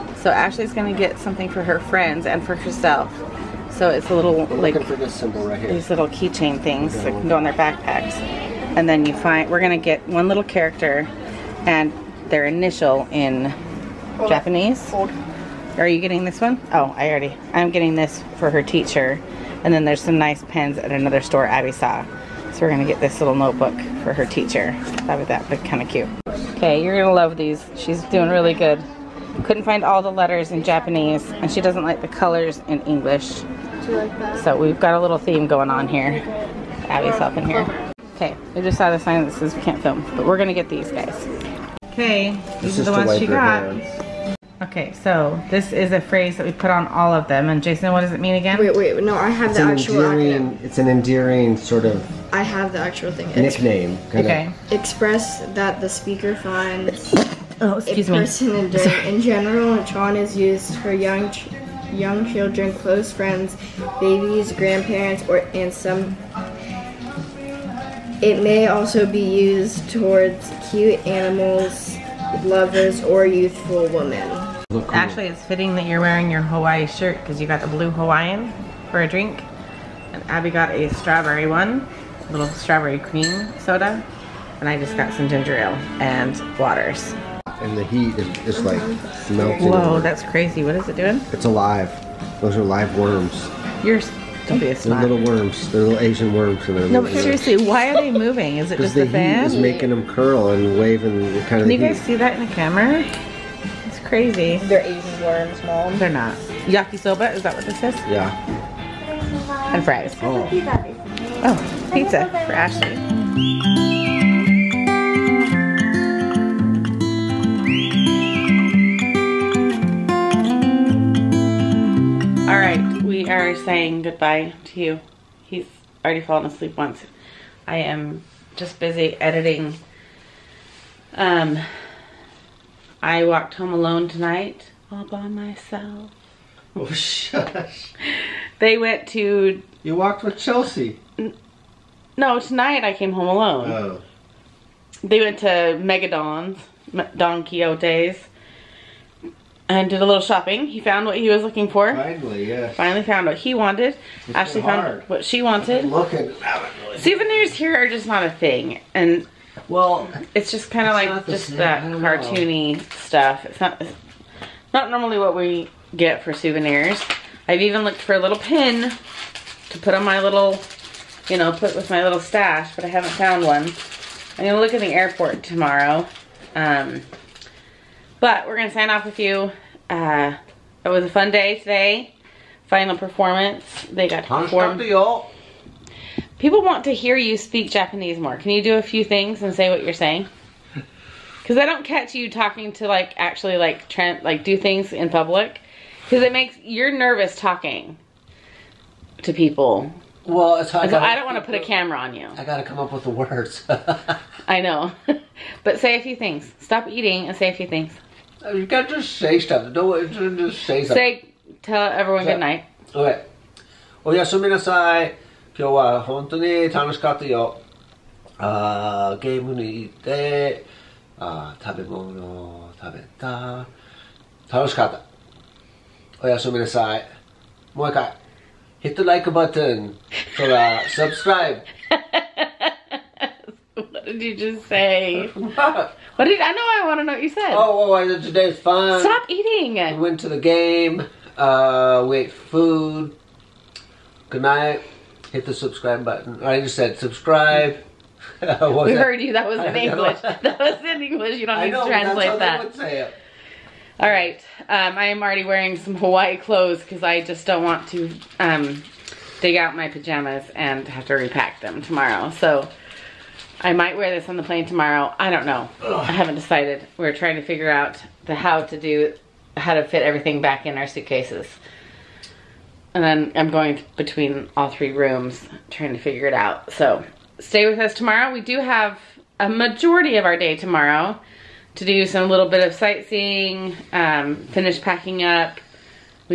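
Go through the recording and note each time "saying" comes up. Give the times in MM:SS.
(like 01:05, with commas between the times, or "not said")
02:03, 03:09.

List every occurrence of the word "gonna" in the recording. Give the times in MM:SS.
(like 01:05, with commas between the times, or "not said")
00:00, 00:09, 00:22, 00:26, 00:40, 02:54, 02:58.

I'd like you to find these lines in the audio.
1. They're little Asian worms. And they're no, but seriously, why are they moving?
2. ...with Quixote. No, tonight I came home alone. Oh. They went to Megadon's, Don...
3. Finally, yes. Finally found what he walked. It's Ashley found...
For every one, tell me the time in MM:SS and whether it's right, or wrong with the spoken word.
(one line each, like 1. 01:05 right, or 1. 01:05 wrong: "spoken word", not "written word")
1. 01:35 right
2. 02:20 wrong: "Chelsea", not "Quixote"
3. 02:31 wrong: "wanted", not "walked".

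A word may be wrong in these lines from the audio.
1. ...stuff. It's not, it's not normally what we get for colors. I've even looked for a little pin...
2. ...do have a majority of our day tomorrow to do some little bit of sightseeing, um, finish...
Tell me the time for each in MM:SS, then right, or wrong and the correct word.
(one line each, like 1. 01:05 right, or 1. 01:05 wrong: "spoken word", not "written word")
1. 02:42 wrong: "souvenirs", not "colors"
2. 04:38 right.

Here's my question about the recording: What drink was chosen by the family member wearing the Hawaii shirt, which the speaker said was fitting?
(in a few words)
Blue Hawaiian.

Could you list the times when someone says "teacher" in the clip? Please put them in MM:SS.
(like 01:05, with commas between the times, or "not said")
00:18, 00:24.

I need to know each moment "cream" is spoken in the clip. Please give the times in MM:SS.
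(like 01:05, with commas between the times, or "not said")
01:22.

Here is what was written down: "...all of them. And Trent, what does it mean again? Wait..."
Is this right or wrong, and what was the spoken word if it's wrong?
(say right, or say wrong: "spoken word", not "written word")
wrong: "Jason", not "Trent".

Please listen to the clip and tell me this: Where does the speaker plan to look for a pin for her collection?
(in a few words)
The airport.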